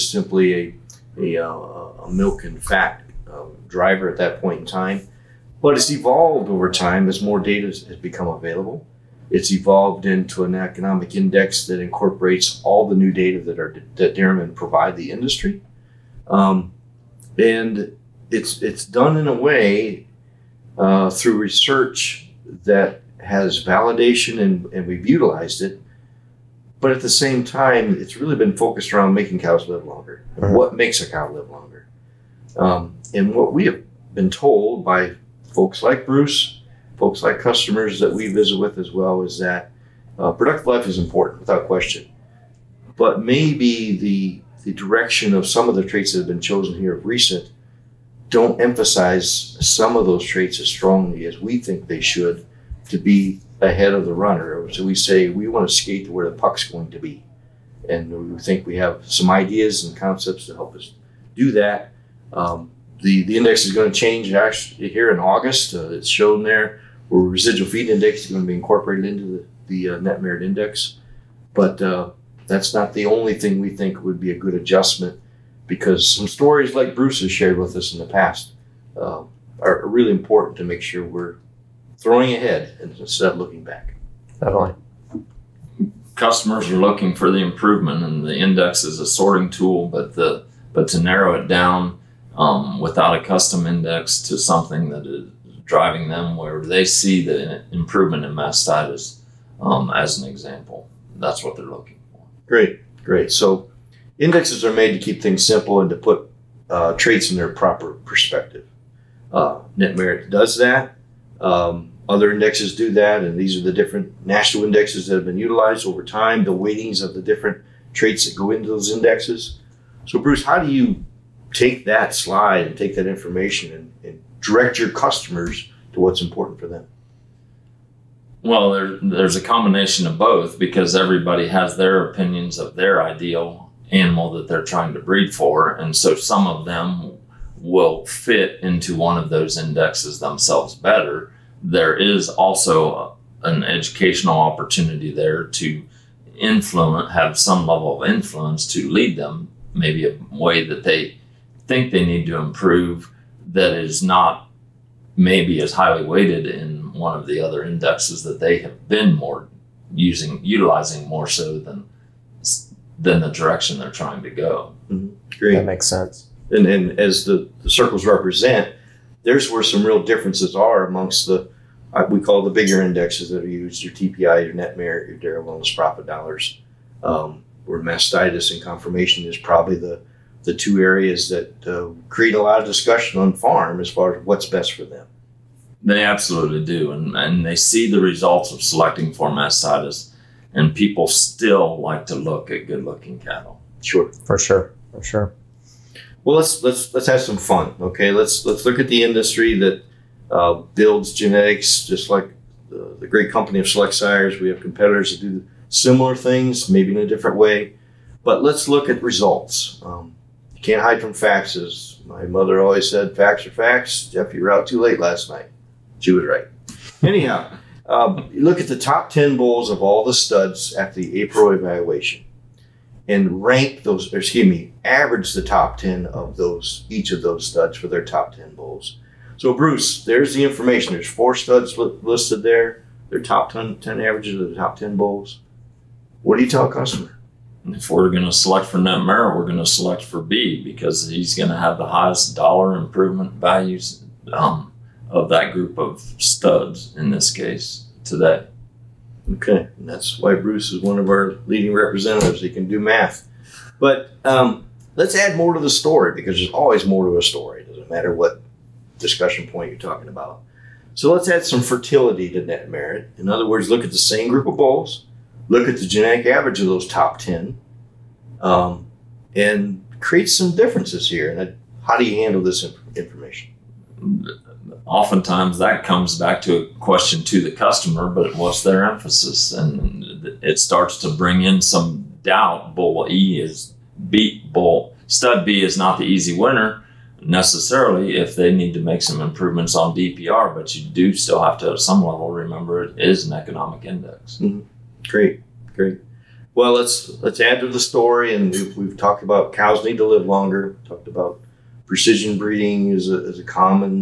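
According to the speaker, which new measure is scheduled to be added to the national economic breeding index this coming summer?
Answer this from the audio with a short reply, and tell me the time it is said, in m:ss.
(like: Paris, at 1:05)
residual feed index, at 1:07.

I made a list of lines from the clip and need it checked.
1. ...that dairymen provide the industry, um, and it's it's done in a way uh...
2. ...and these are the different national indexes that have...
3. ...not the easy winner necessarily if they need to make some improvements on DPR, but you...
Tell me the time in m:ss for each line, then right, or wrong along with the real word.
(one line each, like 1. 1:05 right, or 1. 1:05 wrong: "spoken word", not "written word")
1. 0:13 right
2. 1:53 right
3. 4:45 right.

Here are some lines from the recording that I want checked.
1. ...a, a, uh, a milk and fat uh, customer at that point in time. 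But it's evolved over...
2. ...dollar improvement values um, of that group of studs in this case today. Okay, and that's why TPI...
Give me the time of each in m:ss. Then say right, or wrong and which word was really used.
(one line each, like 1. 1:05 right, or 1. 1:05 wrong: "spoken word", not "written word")
1. 0:00 wrong: "driver", not "customer"
2. 4:02 wrong: "Bruce", not "TPI".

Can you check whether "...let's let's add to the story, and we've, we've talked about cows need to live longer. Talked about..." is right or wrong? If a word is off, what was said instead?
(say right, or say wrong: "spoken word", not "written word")
right.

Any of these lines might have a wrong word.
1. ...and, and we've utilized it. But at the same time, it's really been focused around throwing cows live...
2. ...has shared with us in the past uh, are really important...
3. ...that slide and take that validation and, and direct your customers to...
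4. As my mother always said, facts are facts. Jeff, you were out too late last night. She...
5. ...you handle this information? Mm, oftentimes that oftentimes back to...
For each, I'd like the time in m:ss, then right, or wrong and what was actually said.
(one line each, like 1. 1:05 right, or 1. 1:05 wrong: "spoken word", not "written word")
1. 0:24 wrong: "making", not "throwing"
2. 1:17 right
3. 2:01 wrong: "information", not "validation"
4. 3:31 right
5. 4:32 wrong: "comes", not "oftentimes".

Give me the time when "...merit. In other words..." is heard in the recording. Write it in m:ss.
4:22.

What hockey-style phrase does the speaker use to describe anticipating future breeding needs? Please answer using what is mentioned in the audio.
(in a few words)
skate to where the puck's going.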